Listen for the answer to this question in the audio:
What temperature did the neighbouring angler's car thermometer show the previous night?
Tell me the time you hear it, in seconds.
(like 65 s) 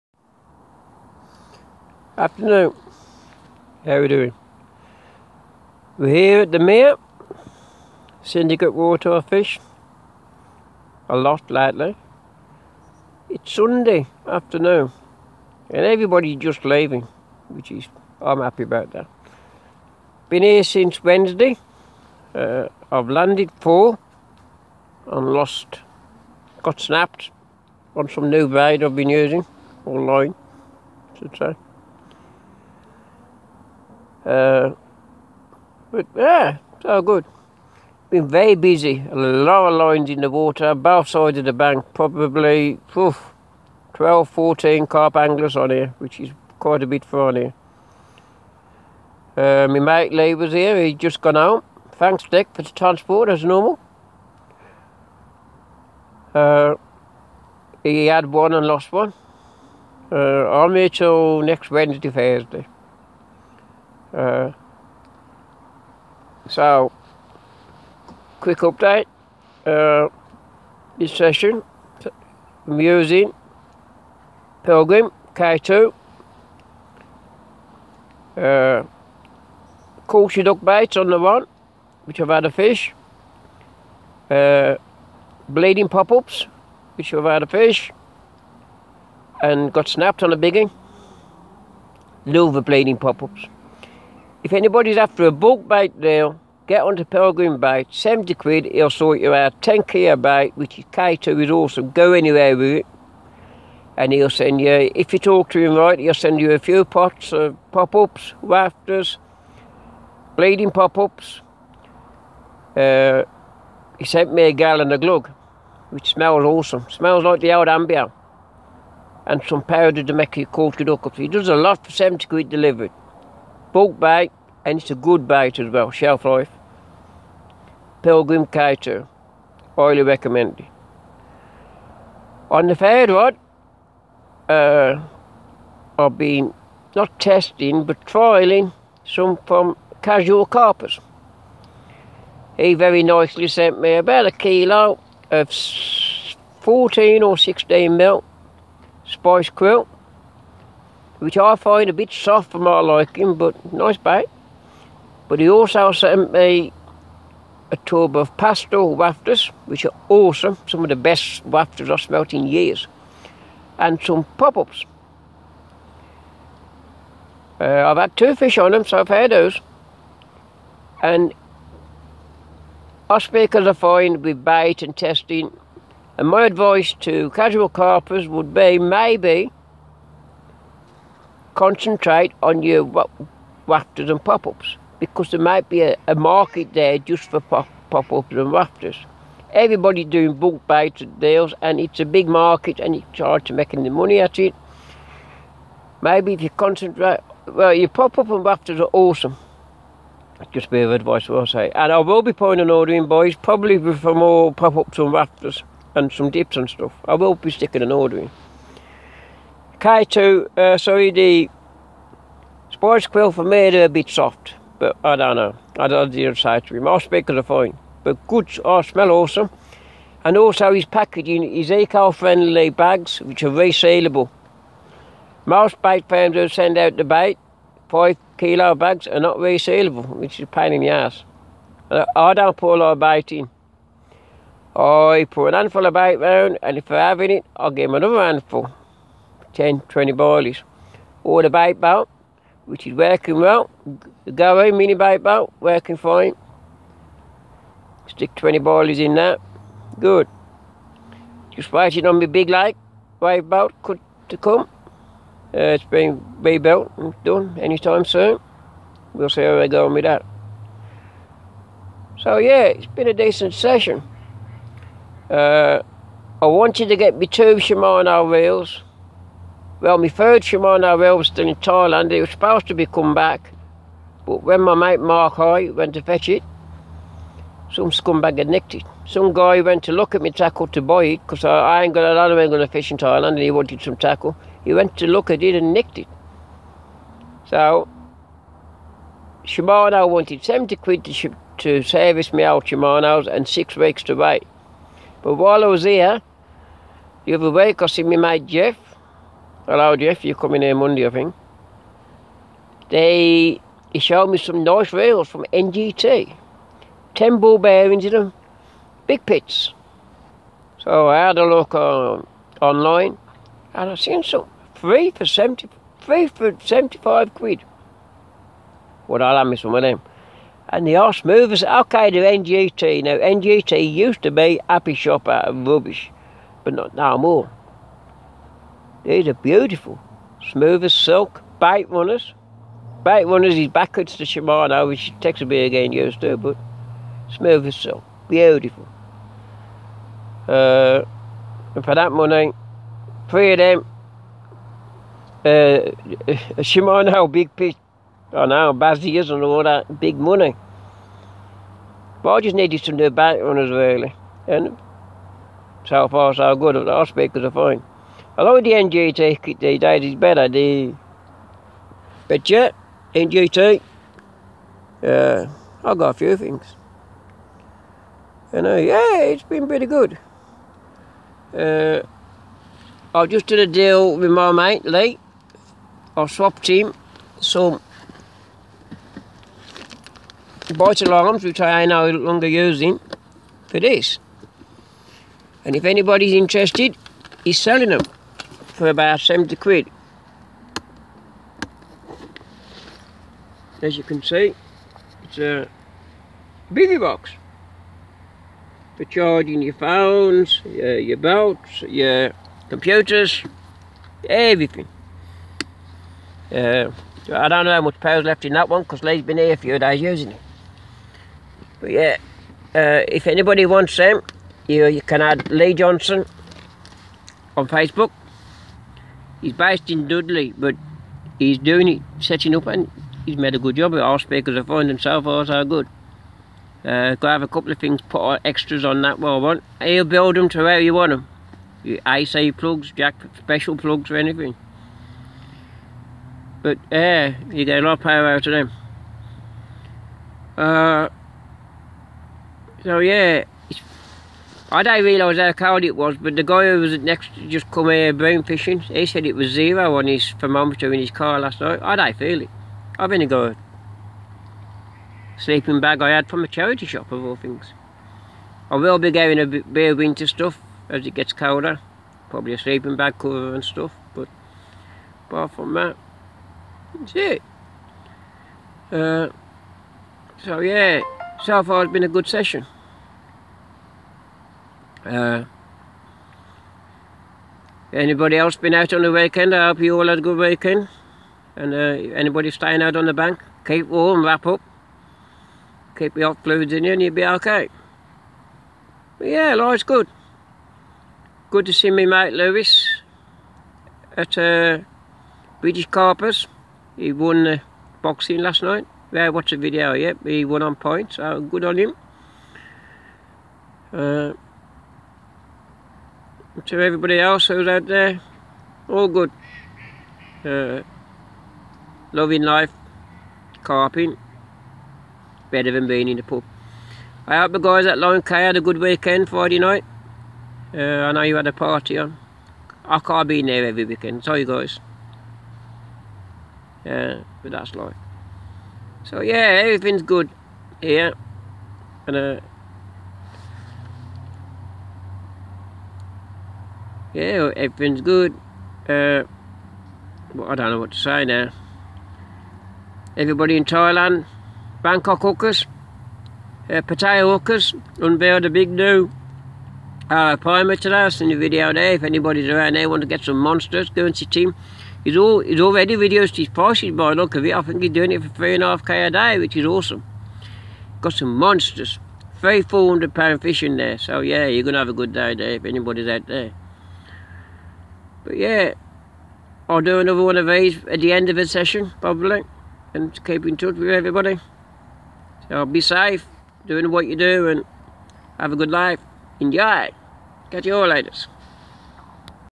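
449 s.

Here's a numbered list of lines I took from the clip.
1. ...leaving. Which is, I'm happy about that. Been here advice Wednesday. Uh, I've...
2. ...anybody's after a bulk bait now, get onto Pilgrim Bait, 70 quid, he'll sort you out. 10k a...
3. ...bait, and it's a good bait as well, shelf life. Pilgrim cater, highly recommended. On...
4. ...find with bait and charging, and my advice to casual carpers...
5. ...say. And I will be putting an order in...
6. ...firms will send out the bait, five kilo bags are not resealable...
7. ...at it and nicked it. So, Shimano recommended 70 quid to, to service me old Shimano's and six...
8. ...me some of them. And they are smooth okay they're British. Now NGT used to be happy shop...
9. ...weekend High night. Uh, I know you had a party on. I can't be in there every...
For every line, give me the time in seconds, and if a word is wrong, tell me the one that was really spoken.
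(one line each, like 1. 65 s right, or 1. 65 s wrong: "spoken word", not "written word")
1. 16 s wrong: "since", not "advice"
2. 94 s right
3. 123 s right
4. 173 s wrong: "testing", not "charging"
5. 201 s right
6. 226 s right
7. 285 s wrong: "wanted", not "recommended"
8. 319 s wrong: "NGT", not "British"
9. 518 s wrong: "Friday", not "High".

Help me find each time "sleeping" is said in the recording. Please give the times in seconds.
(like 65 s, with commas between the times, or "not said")
455 s, 462 s.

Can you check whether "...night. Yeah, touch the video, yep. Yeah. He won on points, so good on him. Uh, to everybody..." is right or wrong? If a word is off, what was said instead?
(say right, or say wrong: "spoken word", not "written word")
wrong: "watch", not "touch".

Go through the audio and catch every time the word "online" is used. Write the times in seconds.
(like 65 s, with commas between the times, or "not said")
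29 s, 312 s.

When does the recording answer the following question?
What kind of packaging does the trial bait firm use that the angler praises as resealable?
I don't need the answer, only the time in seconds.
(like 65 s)
221 s.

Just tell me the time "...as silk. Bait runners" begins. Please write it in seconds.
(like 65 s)
330 s.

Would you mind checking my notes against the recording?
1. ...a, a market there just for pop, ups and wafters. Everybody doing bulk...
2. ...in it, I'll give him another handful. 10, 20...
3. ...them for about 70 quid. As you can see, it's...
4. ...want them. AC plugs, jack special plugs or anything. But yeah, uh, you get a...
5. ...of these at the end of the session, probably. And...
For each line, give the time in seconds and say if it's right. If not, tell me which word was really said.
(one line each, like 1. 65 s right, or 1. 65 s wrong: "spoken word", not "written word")
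1. 185 s right
2. 237 s right
3. 387 s right
4. 430 s right
5. 570 s right.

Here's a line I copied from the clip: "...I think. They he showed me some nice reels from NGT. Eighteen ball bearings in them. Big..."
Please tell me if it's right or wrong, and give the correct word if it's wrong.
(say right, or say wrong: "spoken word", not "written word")
wrong: "Ten", not "Eighteen".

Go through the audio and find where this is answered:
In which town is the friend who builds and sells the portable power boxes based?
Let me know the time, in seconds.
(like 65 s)
420 s.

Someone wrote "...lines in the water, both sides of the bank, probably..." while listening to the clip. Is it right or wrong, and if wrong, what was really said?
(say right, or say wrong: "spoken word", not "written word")
right.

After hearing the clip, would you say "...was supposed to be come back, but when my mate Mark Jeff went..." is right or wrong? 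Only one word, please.
wrong.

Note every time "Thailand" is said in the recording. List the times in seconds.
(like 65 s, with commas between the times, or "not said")
271 s, 282 s, 543 s.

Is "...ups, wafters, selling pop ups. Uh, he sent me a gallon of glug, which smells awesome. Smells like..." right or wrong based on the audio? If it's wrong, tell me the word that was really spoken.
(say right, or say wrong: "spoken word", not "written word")
wrong: "bleeding", not "selling".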